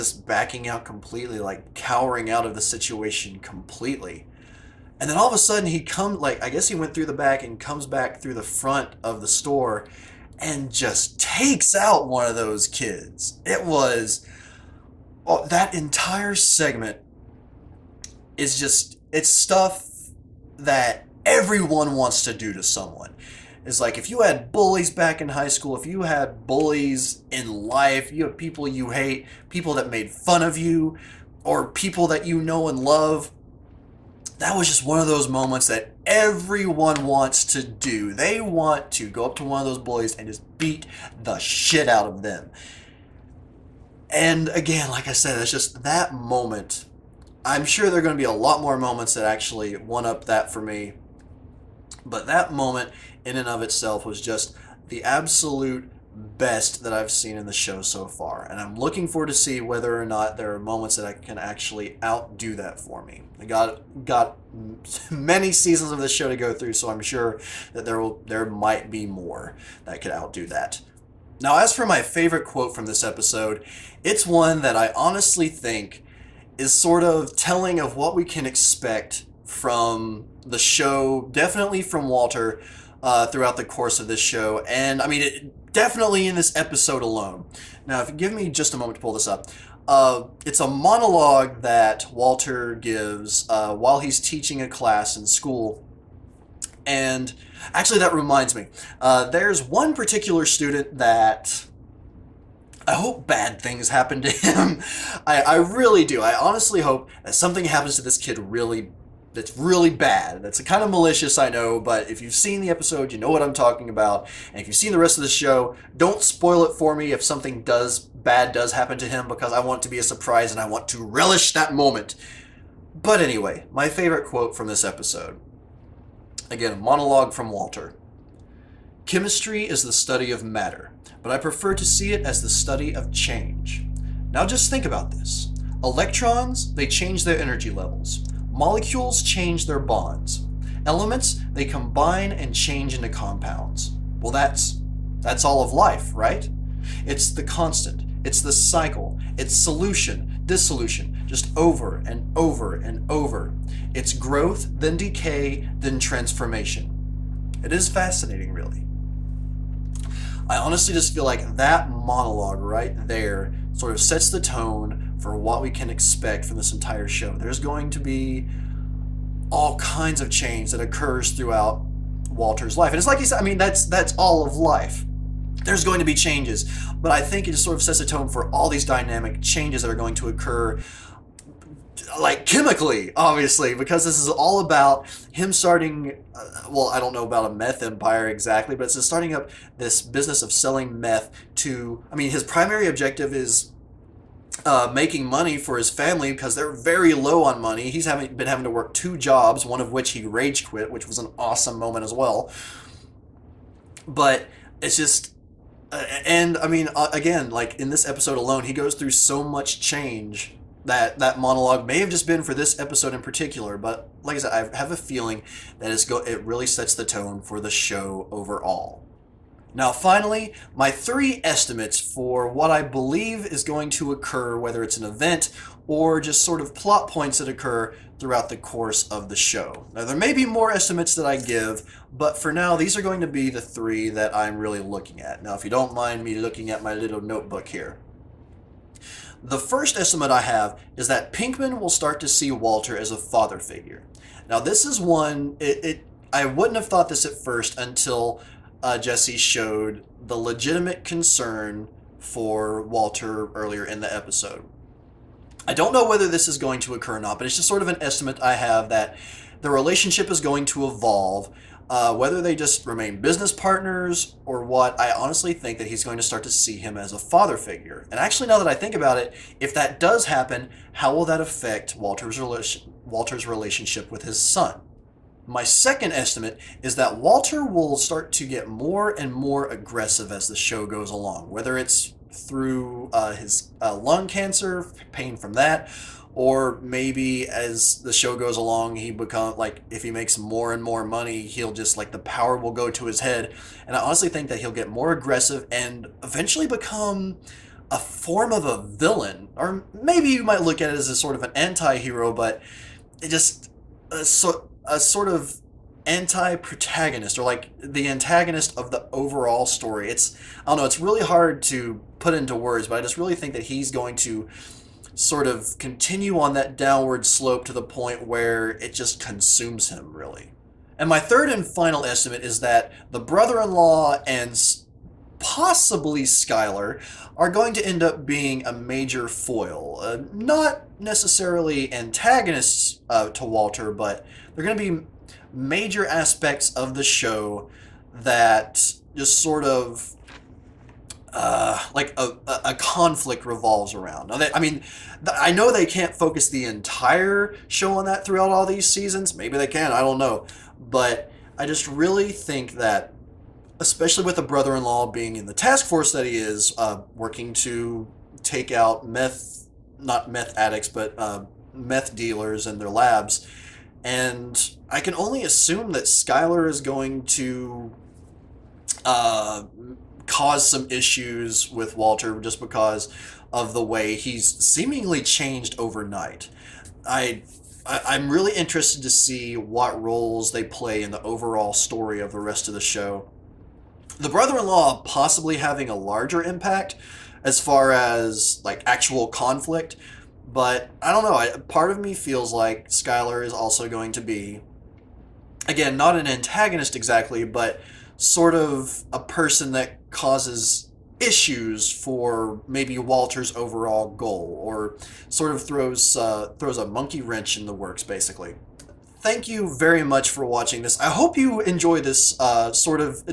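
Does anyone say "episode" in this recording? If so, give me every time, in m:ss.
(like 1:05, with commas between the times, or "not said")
1:13, 1:26, 1:52, 2:04, 3:28, 3:32, 4:14.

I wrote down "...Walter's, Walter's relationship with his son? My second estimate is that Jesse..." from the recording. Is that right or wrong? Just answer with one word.
wrong.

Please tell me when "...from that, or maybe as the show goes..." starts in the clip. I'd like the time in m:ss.
4:45.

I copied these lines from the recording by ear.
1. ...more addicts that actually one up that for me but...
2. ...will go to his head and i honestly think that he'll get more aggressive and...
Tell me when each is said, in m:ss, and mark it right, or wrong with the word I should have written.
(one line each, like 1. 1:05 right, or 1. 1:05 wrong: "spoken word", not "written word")
1. 0:48 wrong: "moments", not "addicts"
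2. 4:52 right.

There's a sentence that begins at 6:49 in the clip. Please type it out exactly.
Thank you very much for watching this.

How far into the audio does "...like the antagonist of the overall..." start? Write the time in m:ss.
5:07.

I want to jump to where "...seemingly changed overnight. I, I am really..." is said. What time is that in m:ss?
6:14.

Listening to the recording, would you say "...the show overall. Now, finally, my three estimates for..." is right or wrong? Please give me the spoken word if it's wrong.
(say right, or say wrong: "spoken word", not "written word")
right.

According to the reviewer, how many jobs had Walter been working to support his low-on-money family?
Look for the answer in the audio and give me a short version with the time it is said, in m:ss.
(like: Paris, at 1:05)
2, at 3:18.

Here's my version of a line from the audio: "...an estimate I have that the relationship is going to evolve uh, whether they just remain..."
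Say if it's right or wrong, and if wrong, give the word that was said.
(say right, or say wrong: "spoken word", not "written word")
right.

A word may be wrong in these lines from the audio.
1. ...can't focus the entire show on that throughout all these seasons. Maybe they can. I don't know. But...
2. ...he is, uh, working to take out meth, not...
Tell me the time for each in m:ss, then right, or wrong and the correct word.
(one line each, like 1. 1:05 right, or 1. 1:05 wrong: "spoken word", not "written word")
1. 5:45 right
2. 5:56 right.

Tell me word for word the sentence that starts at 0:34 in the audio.
That was just one of those moments that everyone wants to do.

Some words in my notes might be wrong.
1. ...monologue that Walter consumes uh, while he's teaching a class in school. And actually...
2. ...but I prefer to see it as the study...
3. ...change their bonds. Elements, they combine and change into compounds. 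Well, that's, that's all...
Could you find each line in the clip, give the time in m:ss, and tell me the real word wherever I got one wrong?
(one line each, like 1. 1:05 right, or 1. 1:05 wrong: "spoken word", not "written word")
1. 1:30 wrong: "gives", not "consumes"
2. 2:11 right
3. 2:19 right.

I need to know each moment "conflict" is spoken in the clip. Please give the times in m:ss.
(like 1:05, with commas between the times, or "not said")
5:42, 6:29.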